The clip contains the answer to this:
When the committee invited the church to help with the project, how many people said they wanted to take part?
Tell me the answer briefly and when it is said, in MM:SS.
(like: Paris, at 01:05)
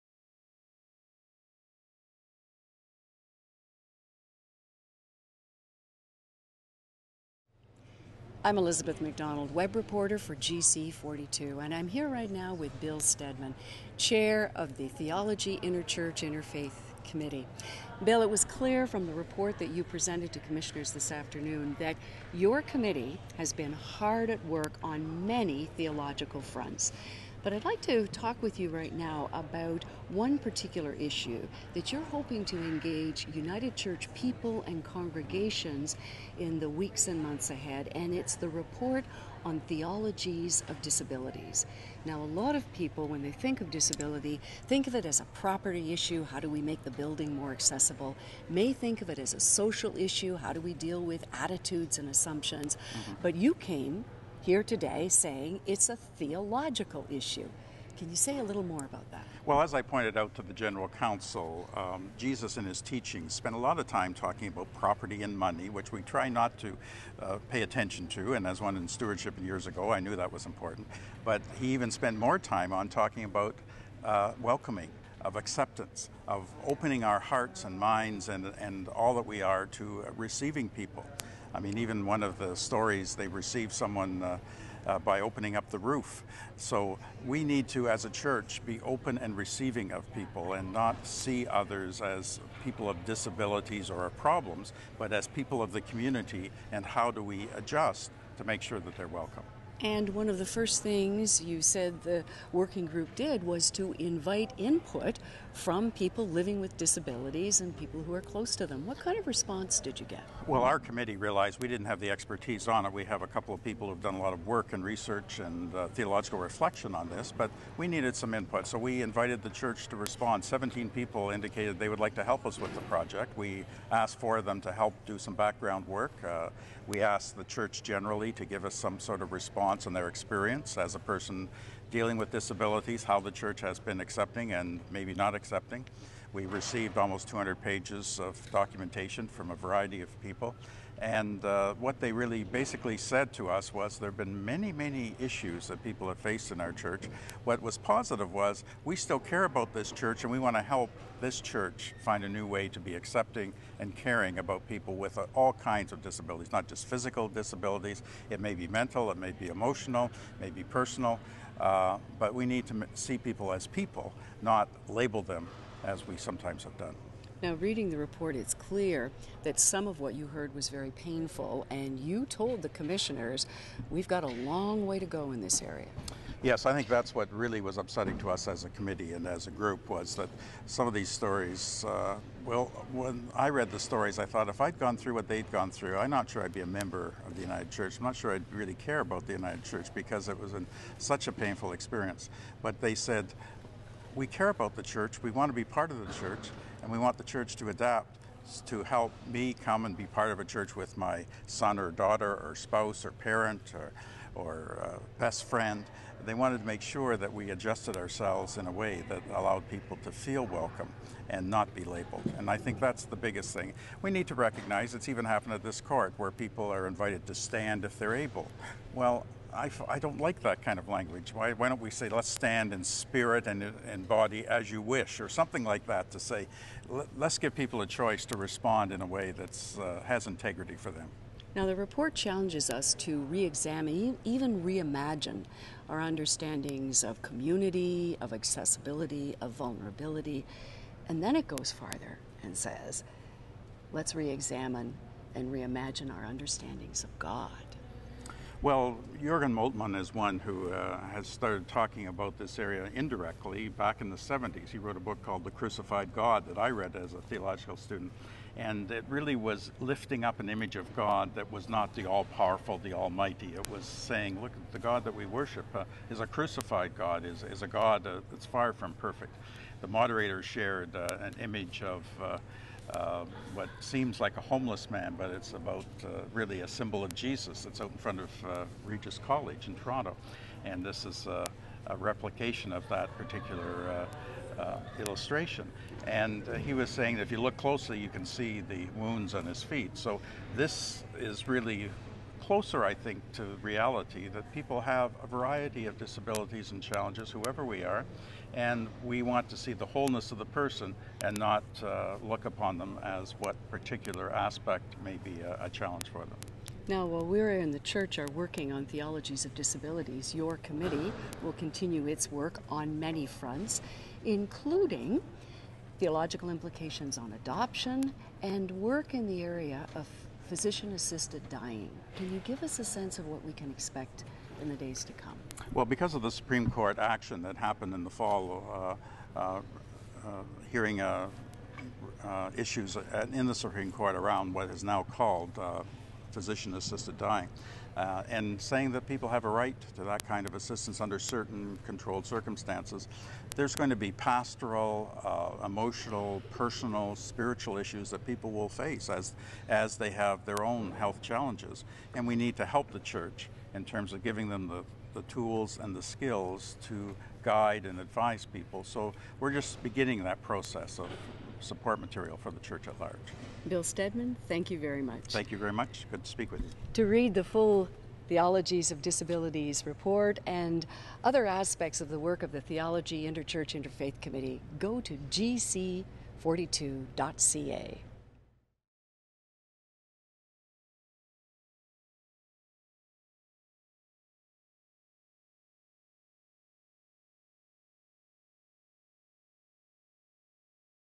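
17, at 02:00.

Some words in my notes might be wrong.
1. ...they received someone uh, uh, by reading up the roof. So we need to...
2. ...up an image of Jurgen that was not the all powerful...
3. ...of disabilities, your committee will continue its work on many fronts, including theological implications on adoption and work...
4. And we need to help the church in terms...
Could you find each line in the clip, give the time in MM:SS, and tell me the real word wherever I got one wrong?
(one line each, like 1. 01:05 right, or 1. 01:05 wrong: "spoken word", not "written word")
1. 01:23 wrong: "opening", not "reading"
2. 04:20 wrong: "God", not "Jurgen"
3. 05:09 right
4. 05:52 right.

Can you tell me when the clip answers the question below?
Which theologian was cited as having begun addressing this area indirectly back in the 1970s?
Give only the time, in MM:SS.
04:09.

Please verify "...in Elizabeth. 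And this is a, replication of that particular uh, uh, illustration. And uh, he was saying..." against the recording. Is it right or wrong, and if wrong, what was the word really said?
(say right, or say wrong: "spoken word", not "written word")
wrong: "Toronto", not "Elizabeth".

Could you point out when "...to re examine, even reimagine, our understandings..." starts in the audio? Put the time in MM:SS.
03:52.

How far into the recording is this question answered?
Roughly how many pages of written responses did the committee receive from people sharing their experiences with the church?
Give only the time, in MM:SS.
02:17.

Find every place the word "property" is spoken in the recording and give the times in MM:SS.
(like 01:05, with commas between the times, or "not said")
00:45, 01:04.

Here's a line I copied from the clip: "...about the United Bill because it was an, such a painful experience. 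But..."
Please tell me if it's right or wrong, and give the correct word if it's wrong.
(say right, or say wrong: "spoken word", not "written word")
wrong: "Church", not "Bill".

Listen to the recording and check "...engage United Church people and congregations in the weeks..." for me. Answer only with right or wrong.
right.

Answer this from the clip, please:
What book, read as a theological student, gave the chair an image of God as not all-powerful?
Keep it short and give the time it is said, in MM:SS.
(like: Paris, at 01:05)
The Crucified God, at 04:15.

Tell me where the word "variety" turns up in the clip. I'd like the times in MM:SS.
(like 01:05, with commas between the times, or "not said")
02:19, 04:55.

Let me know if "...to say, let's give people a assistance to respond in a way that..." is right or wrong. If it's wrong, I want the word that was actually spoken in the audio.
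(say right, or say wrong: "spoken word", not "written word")
wrong: "choice", not "assistance".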